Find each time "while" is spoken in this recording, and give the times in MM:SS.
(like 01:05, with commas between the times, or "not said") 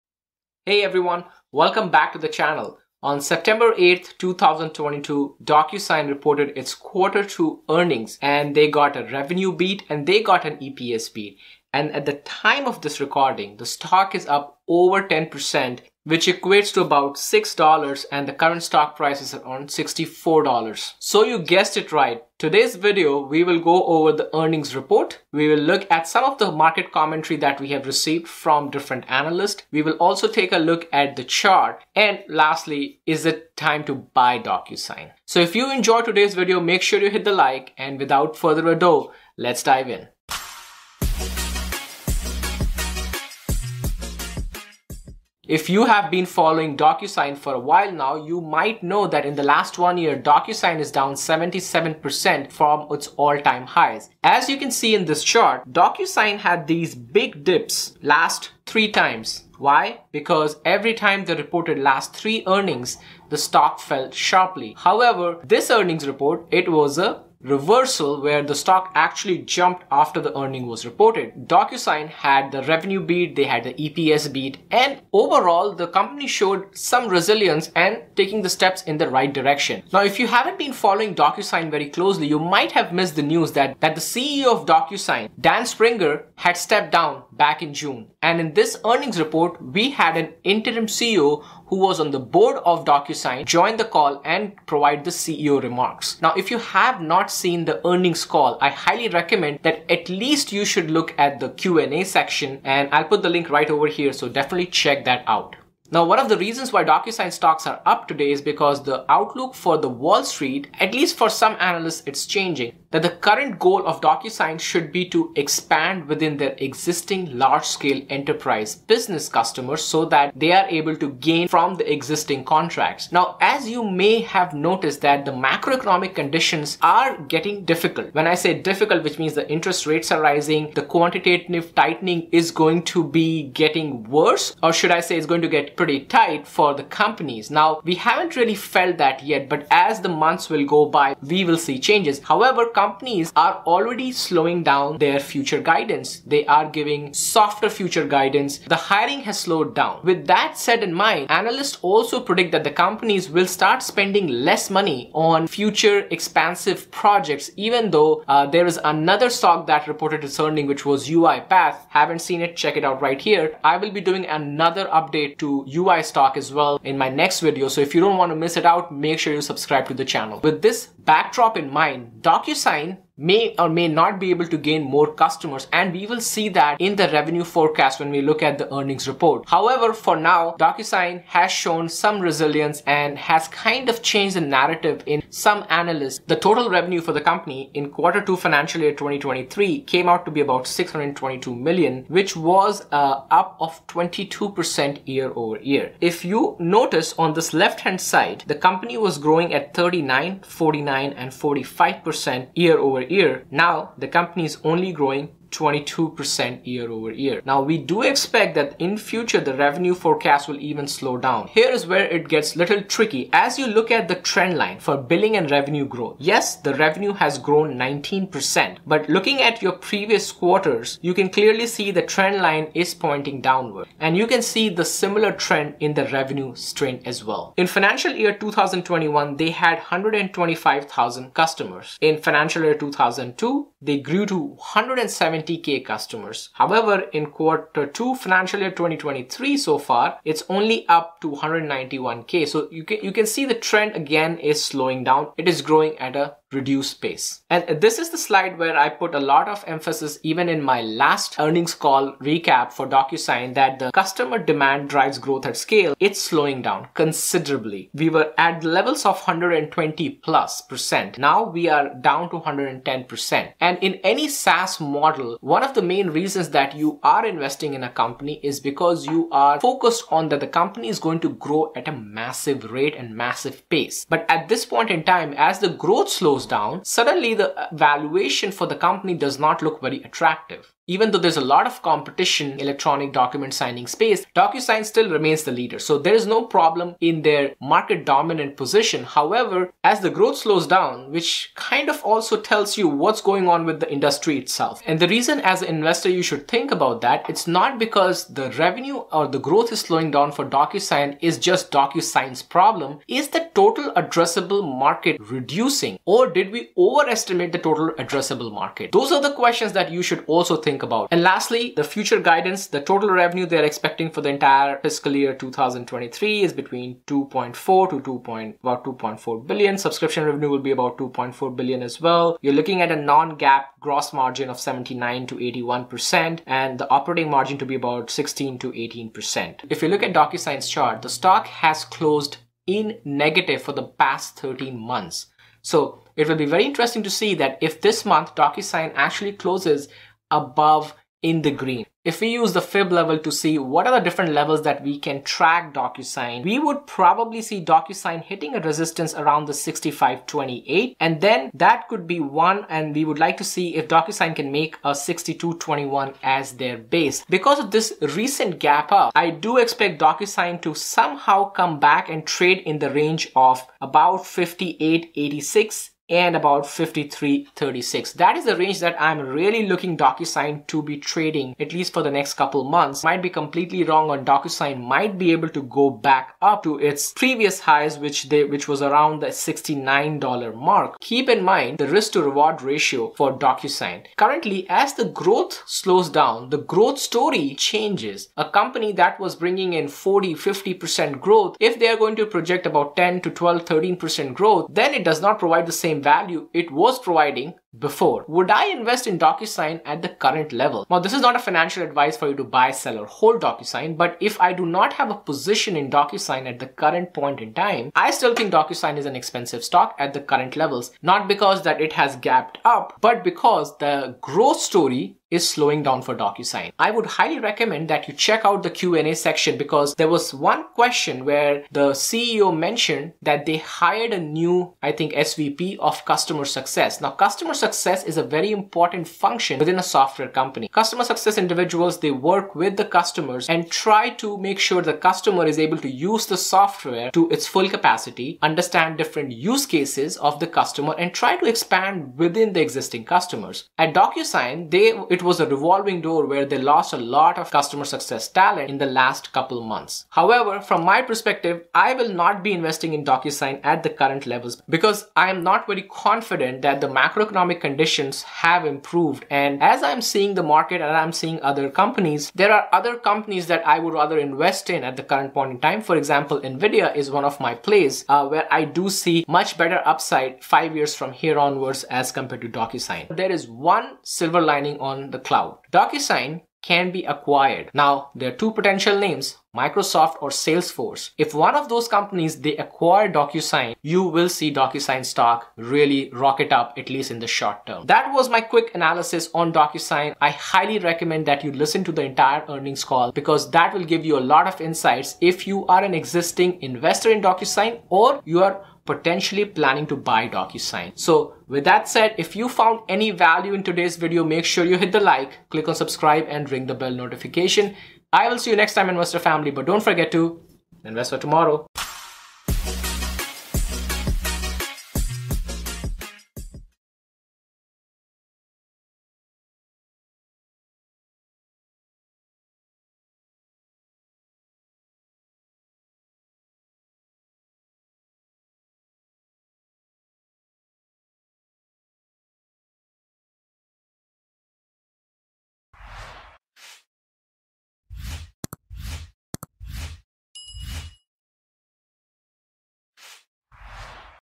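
00:47.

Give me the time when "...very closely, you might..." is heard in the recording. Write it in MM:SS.
01:21.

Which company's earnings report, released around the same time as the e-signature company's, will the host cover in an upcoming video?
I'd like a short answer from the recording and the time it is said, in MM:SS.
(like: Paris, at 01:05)
UiPath, at 02:41.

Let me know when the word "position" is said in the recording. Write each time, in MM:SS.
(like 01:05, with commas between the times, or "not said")
04:48, 06:45.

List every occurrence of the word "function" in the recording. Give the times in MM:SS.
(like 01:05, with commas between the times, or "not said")
07:09.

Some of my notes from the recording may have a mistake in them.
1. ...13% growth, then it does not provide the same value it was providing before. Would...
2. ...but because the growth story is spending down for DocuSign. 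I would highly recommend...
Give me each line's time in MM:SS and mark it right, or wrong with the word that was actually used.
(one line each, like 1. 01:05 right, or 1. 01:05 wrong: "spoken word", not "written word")
1. 06:33 right
2. 06:53 wrong: "slowing", not "spending".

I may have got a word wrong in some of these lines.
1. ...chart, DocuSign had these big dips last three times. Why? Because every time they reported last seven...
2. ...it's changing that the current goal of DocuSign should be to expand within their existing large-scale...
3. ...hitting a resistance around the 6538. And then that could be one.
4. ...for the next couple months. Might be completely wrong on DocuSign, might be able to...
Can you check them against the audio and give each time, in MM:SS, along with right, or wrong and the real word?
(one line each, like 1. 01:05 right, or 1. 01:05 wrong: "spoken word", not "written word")
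1. 00:55 wrong: "three", not "seven"
2. 01:52 right
3. 05:48 wrong: "6528", not "6538"
4. 06:11 right.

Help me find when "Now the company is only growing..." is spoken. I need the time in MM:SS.
03:23.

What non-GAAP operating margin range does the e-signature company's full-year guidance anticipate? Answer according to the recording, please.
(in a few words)
16 to 18%.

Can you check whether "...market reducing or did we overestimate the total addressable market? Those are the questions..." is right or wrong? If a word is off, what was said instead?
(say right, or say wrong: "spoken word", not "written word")
right.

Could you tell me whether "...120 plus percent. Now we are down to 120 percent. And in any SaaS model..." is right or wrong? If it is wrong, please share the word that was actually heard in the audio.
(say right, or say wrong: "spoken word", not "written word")
wrong: "110", not "120".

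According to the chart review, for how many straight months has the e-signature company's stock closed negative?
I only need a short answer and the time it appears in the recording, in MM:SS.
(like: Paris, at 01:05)
13, at 05:34.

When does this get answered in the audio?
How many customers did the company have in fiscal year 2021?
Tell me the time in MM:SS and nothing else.
03:49.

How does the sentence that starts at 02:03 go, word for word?
Now, as you may have noticed that the macroeconomic conditions are getting difficult.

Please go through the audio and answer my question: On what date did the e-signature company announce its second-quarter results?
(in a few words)
September 8th, 2022.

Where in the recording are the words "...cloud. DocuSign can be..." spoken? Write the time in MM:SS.
07:55.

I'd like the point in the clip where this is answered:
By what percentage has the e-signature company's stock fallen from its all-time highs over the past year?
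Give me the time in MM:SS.
00:51.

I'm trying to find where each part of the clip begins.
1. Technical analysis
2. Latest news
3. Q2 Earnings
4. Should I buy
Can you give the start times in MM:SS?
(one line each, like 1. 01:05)
1. 05:29
2. 00:45
3. 03:06
4. 06:21.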